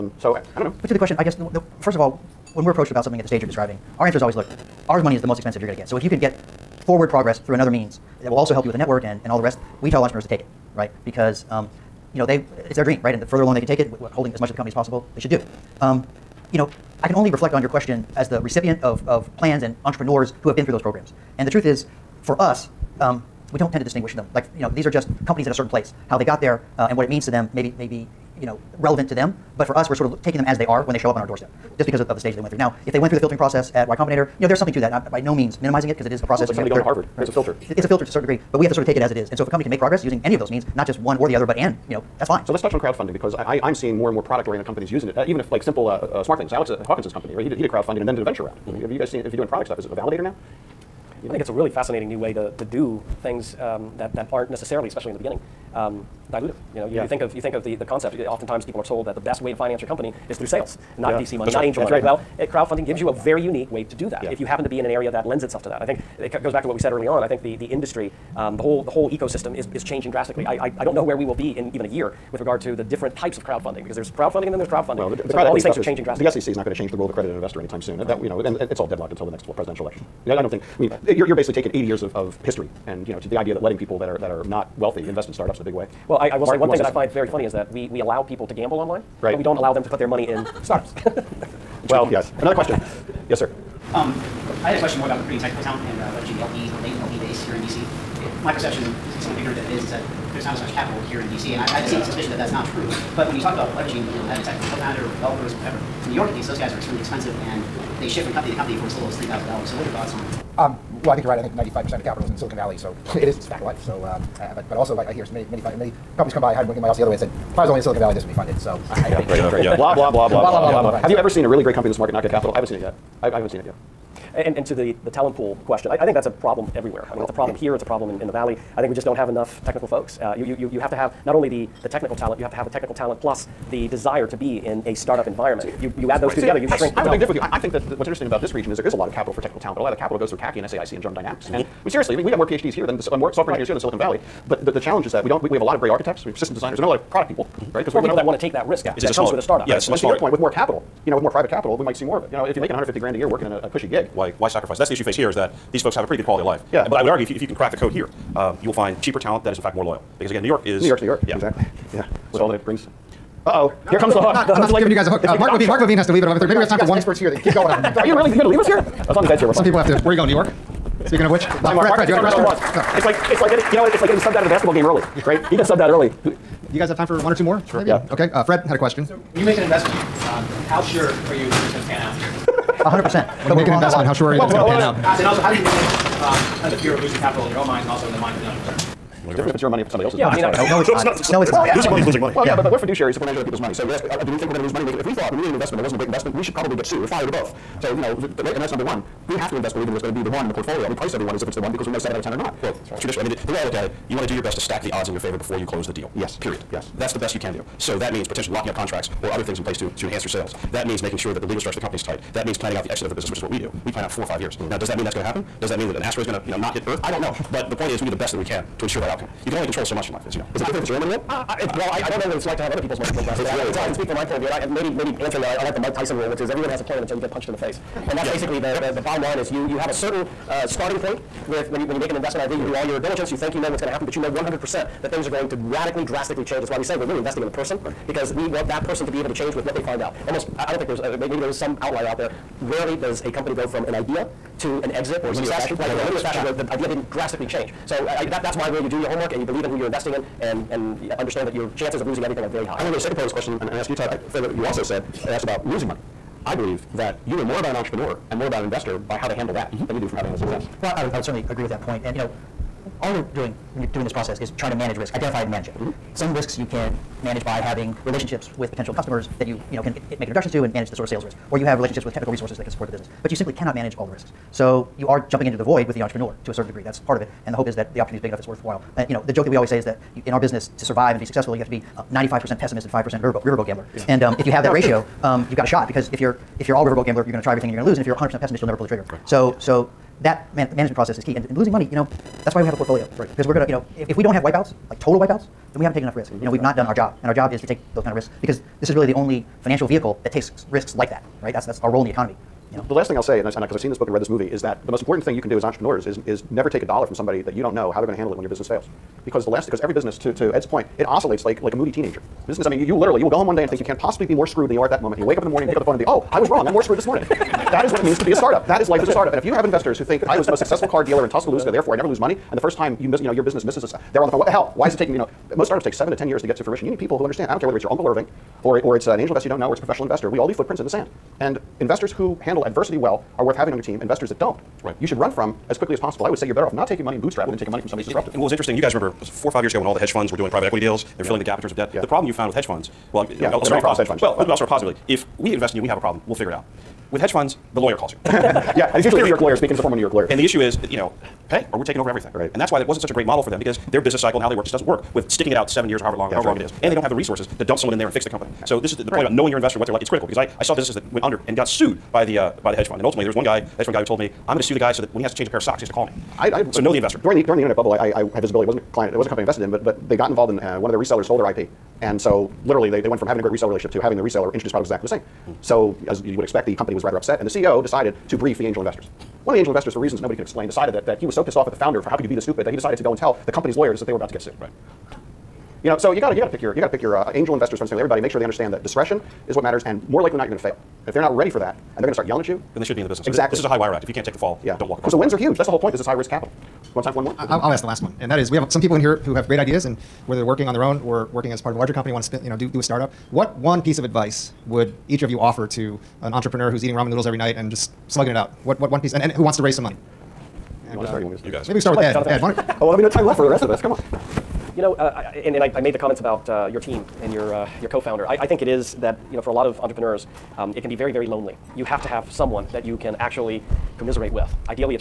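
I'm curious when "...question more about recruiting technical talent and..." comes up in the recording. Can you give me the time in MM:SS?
01:34.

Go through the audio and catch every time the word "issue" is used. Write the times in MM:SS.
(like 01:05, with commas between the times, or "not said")
02:34, 05:50.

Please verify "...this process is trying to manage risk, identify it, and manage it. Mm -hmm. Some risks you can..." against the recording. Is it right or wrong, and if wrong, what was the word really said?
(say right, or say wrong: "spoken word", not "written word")
right.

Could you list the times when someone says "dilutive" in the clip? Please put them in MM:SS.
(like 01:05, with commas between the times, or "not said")
00:56.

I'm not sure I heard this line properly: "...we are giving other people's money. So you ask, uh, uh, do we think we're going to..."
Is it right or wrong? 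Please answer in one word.
wrong.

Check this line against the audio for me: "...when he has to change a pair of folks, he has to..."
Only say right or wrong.
wrong.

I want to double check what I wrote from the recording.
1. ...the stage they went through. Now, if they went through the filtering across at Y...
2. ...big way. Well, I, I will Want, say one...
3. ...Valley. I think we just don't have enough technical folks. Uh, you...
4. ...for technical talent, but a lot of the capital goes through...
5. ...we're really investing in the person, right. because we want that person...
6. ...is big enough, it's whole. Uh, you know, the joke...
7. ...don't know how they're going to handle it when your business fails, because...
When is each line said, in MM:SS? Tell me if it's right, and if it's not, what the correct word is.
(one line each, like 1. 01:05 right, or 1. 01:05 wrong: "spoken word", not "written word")
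1. 00:32 wrong: "process", not "across"
2. 01:25 wrong: "Mark", not "Want"
3. 02:08 right
4. 02:19 right
5. 03:56 right
6. 04:38 wrong: "worthwhile", not "whole"
7. 05:07 right.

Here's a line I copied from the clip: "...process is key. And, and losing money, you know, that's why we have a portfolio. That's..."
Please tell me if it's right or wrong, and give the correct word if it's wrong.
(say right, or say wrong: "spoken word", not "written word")
right.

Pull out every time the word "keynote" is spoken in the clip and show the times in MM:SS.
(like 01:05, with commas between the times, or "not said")
not said.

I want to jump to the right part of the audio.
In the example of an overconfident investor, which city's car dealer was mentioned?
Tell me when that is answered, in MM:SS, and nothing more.
05:21.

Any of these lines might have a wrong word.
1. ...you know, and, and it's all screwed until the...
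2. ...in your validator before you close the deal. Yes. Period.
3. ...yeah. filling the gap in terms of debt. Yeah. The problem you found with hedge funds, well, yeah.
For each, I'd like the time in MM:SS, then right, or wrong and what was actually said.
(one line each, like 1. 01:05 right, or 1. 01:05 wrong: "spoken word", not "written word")
1. 01:18 wrong: "deadlocked", not "screwed"
2. 03:25 wrong: "favor", not "validator"
3. 05:41 right.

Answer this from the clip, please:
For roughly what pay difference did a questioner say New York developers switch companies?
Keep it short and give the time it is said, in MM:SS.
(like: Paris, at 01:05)
$3,000, at 01:49.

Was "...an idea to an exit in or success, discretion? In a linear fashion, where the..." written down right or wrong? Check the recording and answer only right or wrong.
wrong.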